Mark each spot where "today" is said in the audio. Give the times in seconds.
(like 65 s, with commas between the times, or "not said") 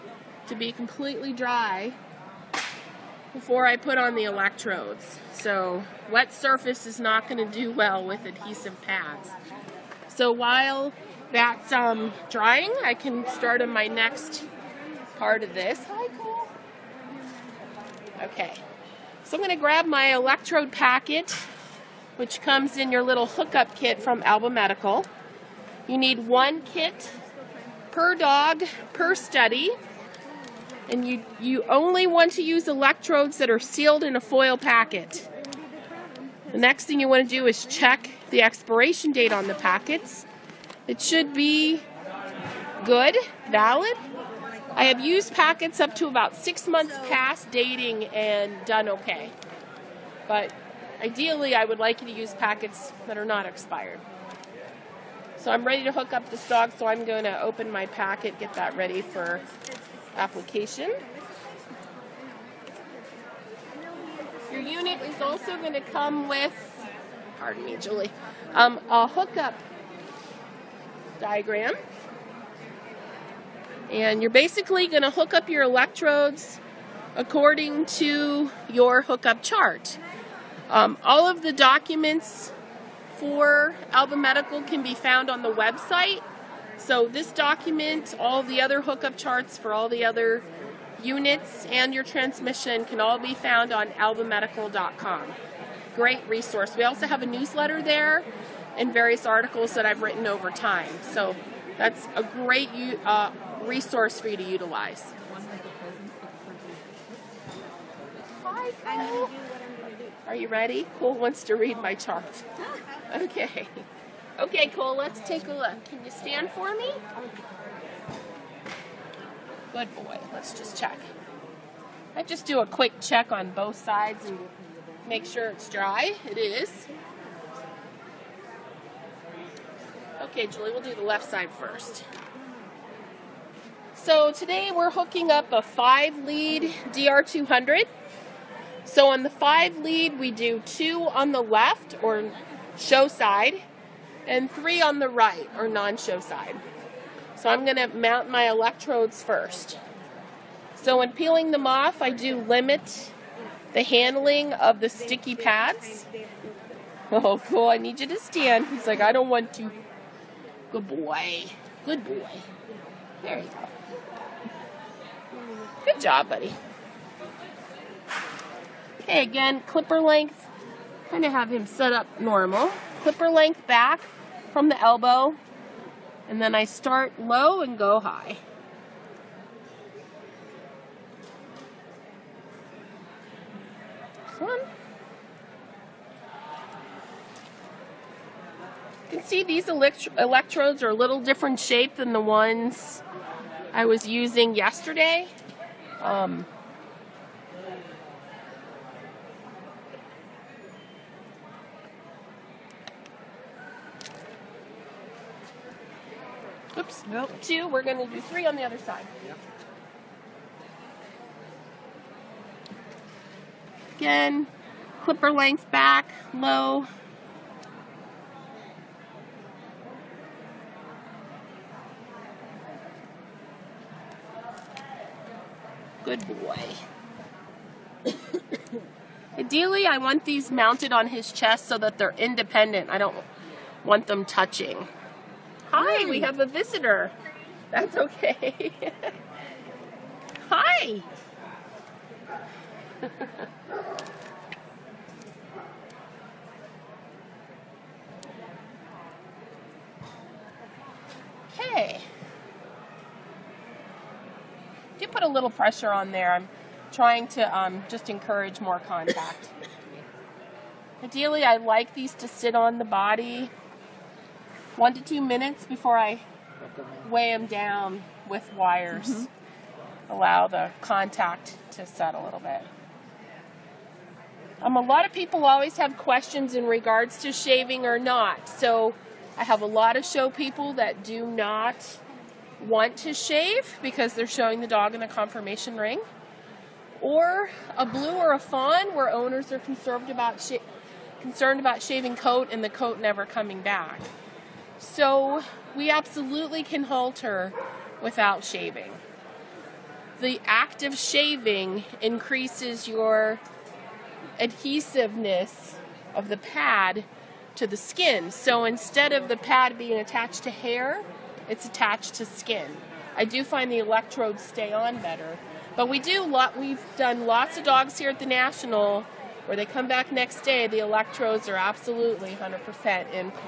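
134 s.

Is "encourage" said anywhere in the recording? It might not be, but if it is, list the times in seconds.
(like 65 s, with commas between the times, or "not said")
258 s.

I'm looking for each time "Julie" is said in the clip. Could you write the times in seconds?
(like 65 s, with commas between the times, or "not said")
67 s, 130 s.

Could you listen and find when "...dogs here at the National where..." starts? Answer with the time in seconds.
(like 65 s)
317 s.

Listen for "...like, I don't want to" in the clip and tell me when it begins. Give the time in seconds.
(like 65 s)
158 s.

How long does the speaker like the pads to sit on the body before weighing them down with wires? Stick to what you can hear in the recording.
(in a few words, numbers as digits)
1 to 2 minutes.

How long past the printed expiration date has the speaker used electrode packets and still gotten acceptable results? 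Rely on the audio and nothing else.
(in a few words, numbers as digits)
about 6 months.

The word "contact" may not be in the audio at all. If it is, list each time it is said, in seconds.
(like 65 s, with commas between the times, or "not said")
258 s, 270 s.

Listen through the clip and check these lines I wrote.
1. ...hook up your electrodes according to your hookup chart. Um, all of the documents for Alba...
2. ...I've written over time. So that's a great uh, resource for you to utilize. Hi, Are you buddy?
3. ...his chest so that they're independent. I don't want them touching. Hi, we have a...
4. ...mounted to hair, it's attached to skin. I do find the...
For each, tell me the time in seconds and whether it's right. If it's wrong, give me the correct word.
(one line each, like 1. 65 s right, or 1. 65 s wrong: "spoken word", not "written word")
1. 75 s right
2. 99 s wrong: "ready", not "buddy"
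3. 231 s right
4. 309 s wrong: "attached", not "mounted".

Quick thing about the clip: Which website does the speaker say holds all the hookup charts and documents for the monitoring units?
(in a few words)
albamedical.com.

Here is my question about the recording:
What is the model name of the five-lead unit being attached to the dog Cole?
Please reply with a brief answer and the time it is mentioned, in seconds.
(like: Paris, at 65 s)
DR200, at 136 s.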